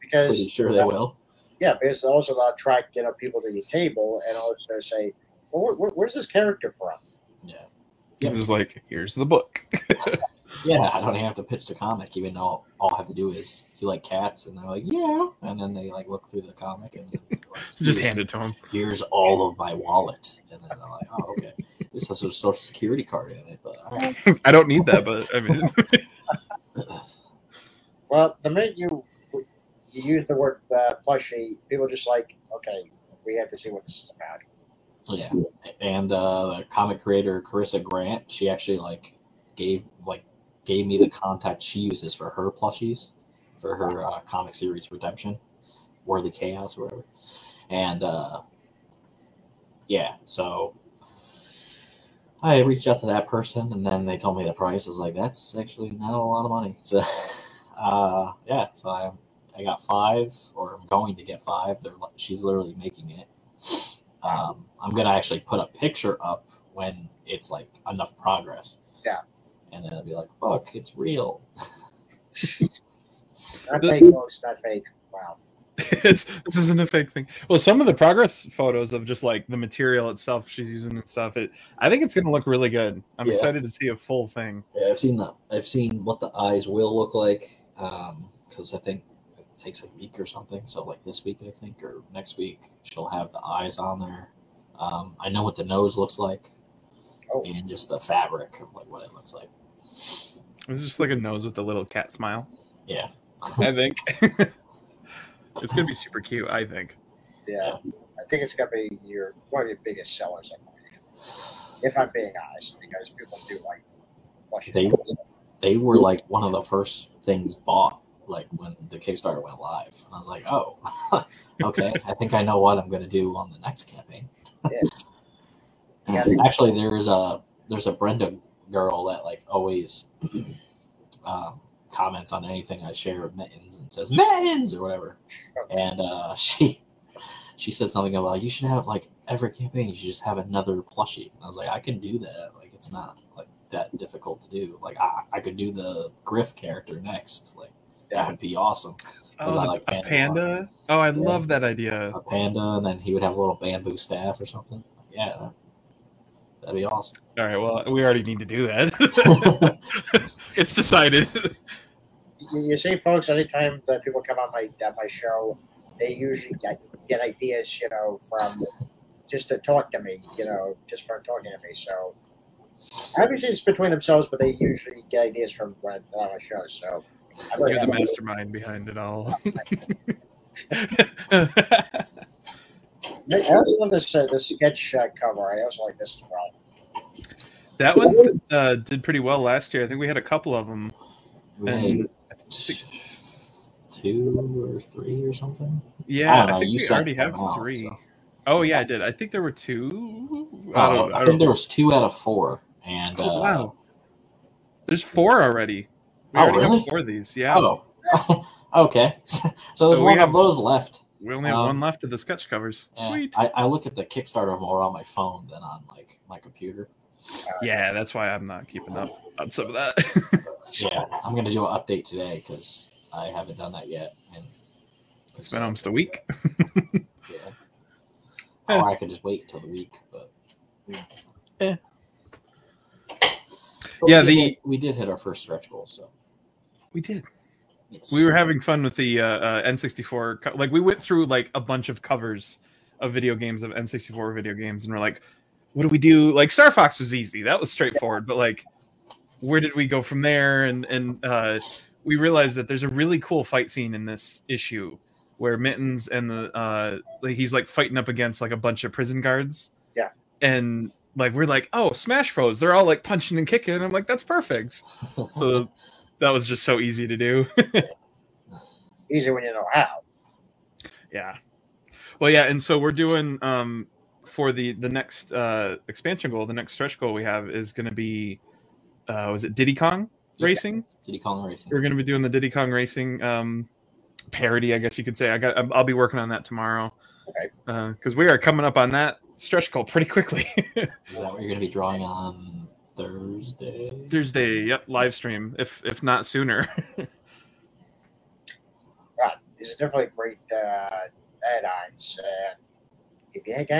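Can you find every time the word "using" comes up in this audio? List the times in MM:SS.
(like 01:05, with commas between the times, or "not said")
01:20.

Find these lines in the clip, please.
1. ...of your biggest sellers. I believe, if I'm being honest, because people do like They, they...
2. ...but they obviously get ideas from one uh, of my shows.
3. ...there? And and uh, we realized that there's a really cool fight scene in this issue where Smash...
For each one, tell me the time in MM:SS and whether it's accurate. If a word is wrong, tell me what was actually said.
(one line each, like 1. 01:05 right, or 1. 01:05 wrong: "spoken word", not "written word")
1. 01:49 right
2. 02:54 wrong: "usually", not "obviously"
3. 04:10 wrong: "Mittens", not "Smash".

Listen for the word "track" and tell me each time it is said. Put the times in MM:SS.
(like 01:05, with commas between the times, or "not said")
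00:02.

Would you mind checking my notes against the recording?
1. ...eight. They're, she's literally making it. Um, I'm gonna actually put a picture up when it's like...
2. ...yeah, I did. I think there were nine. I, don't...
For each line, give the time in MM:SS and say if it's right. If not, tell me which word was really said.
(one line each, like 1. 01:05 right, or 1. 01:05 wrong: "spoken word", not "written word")
1. 01:01 wrong: "five", not "eight"
2. 03:18 wrong: "two", not "nine".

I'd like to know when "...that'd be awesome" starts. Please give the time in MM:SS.
02:36.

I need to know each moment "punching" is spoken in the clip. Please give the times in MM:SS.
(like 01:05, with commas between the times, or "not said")
04:23.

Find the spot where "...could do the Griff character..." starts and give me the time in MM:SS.
02:25.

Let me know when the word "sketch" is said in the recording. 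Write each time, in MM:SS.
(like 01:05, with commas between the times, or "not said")
03:04, 03:32.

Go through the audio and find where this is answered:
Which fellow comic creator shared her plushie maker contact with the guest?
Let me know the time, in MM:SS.
00:37.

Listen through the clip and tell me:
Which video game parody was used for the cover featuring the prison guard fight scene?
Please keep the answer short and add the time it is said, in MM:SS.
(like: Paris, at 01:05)
Smash Bros., at 04:21.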